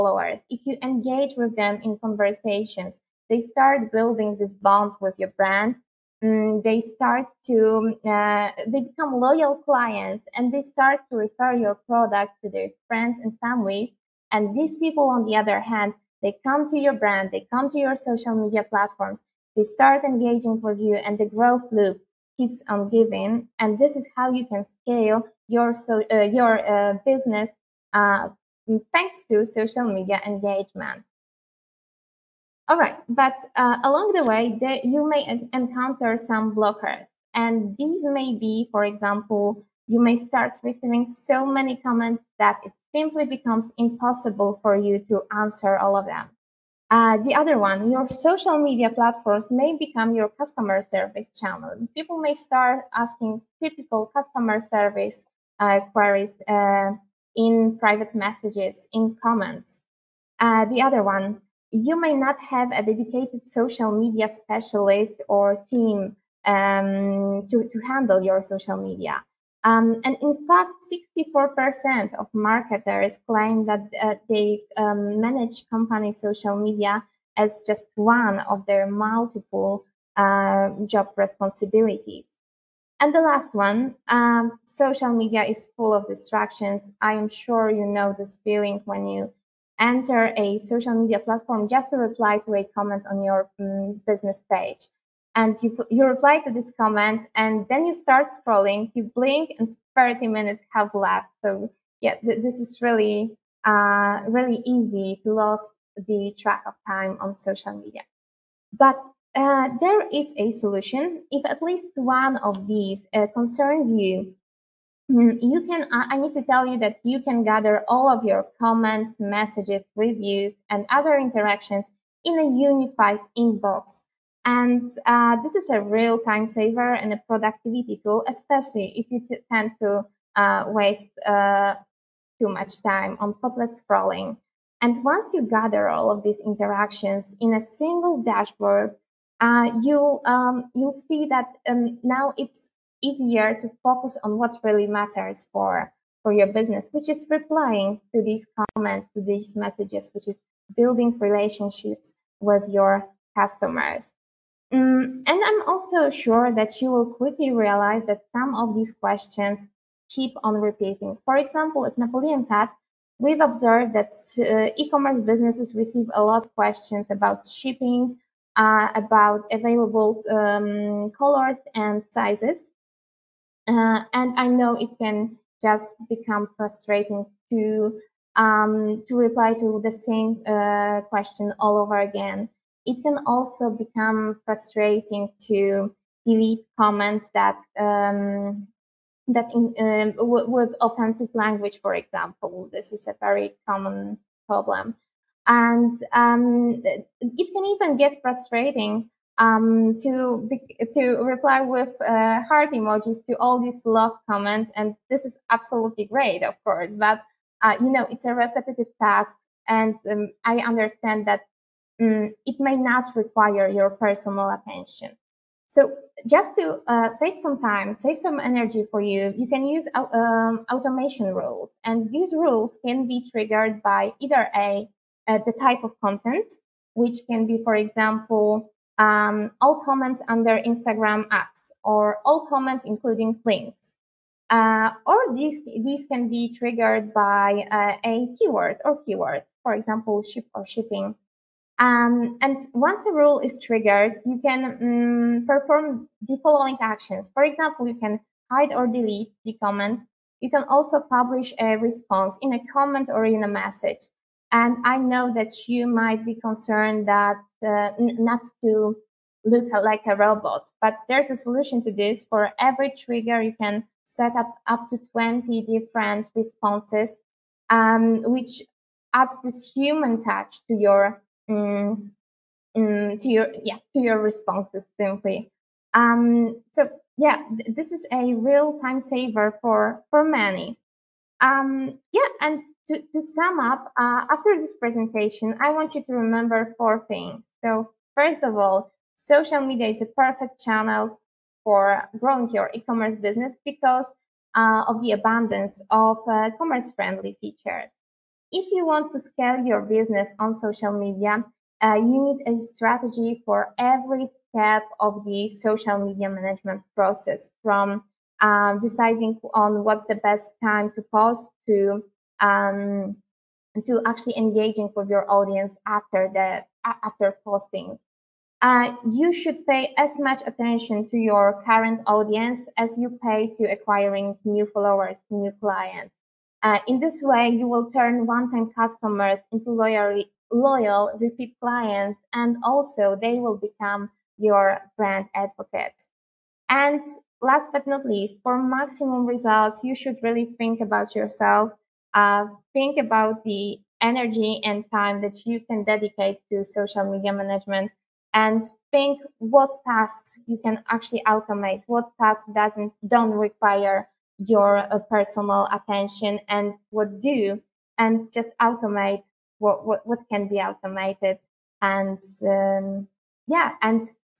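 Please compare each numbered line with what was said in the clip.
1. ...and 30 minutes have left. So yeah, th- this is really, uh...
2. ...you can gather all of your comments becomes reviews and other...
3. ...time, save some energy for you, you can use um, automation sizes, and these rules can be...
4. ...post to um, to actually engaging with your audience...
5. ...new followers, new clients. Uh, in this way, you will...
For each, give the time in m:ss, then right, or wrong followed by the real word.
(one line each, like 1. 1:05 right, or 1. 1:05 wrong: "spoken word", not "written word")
1. 1:39 right
2. 1:57 wrong: "messages", not "becomes"
3. 3:37 wrong: "rules", not "sizes"
4. 5:11 right
5. 5:24 right.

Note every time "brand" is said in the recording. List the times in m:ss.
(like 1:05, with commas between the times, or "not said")
0:05, 0:16, 5:34.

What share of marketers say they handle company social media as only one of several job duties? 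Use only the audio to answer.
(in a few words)
64%.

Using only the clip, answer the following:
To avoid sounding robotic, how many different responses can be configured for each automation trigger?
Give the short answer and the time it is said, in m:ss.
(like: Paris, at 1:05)
20, at 4:24.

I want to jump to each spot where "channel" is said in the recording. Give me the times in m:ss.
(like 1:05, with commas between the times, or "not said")
0:51, 4:50.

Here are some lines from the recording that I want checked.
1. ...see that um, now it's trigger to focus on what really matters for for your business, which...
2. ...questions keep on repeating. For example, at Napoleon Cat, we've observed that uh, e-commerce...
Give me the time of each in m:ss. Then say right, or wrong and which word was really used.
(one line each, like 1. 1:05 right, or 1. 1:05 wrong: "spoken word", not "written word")
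1. 2:21 wrong: "easier", not "trigger"
2. 2:38 right.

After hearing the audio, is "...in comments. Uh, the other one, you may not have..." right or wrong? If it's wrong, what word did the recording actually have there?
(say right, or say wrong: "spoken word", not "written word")
right.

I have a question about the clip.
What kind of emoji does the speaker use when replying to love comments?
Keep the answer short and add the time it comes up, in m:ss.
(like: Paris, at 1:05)
Heart emojis, at 3:22.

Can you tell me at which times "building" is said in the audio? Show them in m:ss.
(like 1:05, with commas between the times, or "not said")
0:03, 2:30.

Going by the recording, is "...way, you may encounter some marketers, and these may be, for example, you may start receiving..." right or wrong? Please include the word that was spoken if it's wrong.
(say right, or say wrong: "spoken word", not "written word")
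wrong: "blockers", not "marketers".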